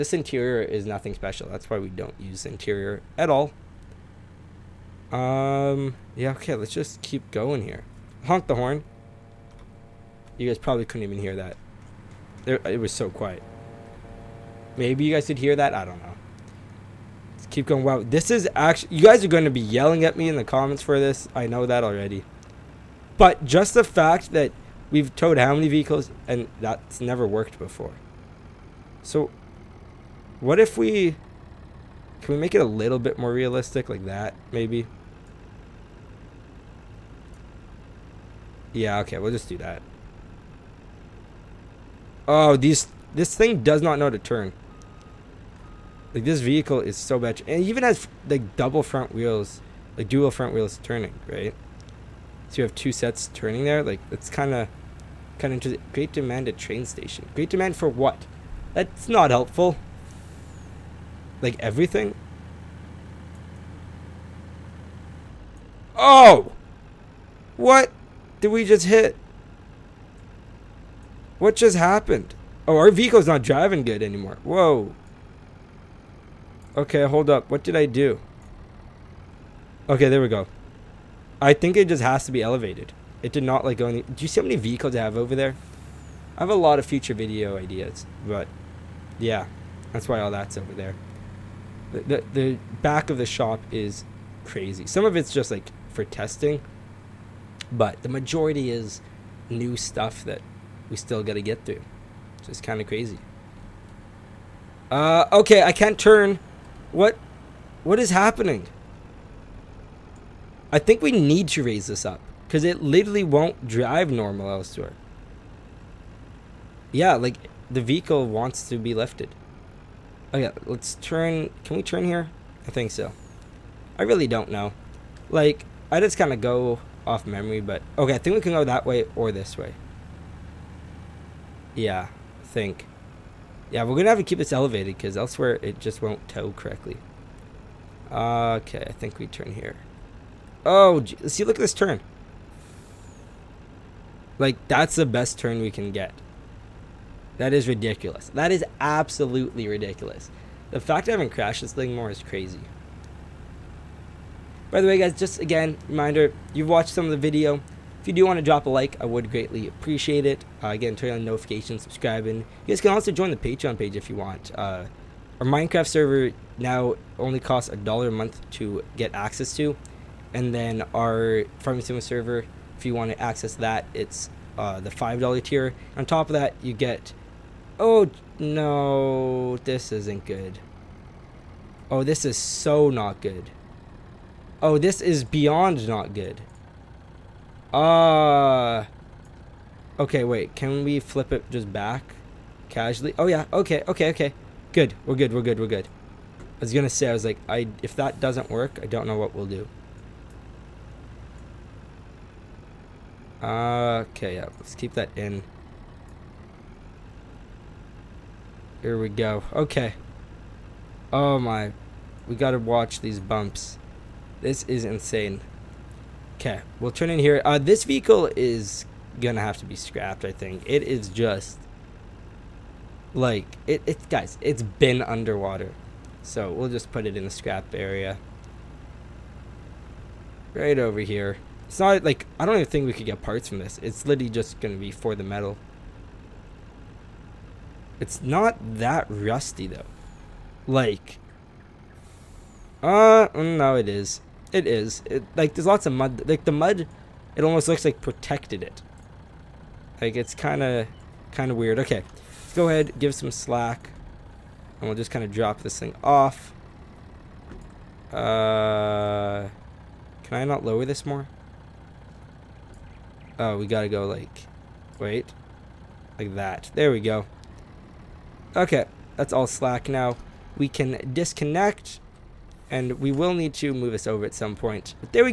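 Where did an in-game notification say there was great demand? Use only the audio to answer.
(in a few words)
train station.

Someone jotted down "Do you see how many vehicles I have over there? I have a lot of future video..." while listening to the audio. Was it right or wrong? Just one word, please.
right.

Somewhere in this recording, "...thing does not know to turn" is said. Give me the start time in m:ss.
0:43.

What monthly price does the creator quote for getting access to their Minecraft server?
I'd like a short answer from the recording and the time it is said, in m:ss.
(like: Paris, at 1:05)
$1, at 2:47.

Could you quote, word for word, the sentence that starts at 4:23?
Oh, we gotta go like, wait, like that.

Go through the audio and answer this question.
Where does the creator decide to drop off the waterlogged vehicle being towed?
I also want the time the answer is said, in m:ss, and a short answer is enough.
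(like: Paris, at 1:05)
the scrap area, at 3:47.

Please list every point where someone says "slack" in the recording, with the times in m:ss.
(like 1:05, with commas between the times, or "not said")
4:13, 4:29.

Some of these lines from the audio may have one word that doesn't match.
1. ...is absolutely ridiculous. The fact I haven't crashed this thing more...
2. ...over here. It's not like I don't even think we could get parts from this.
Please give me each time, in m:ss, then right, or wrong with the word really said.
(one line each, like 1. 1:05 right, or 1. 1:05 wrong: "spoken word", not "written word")
1. 2:28 right
2. 3:50 right.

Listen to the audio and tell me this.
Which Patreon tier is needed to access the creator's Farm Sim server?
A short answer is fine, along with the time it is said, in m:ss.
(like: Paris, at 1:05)
$5 tier, at 2:54.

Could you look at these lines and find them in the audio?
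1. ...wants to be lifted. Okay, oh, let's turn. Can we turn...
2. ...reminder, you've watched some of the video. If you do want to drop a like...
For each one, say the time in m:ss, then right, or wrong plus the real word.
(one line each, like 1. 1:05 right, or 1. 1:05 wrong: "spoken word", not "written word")
1. 1:58 right
2. 2:35 right.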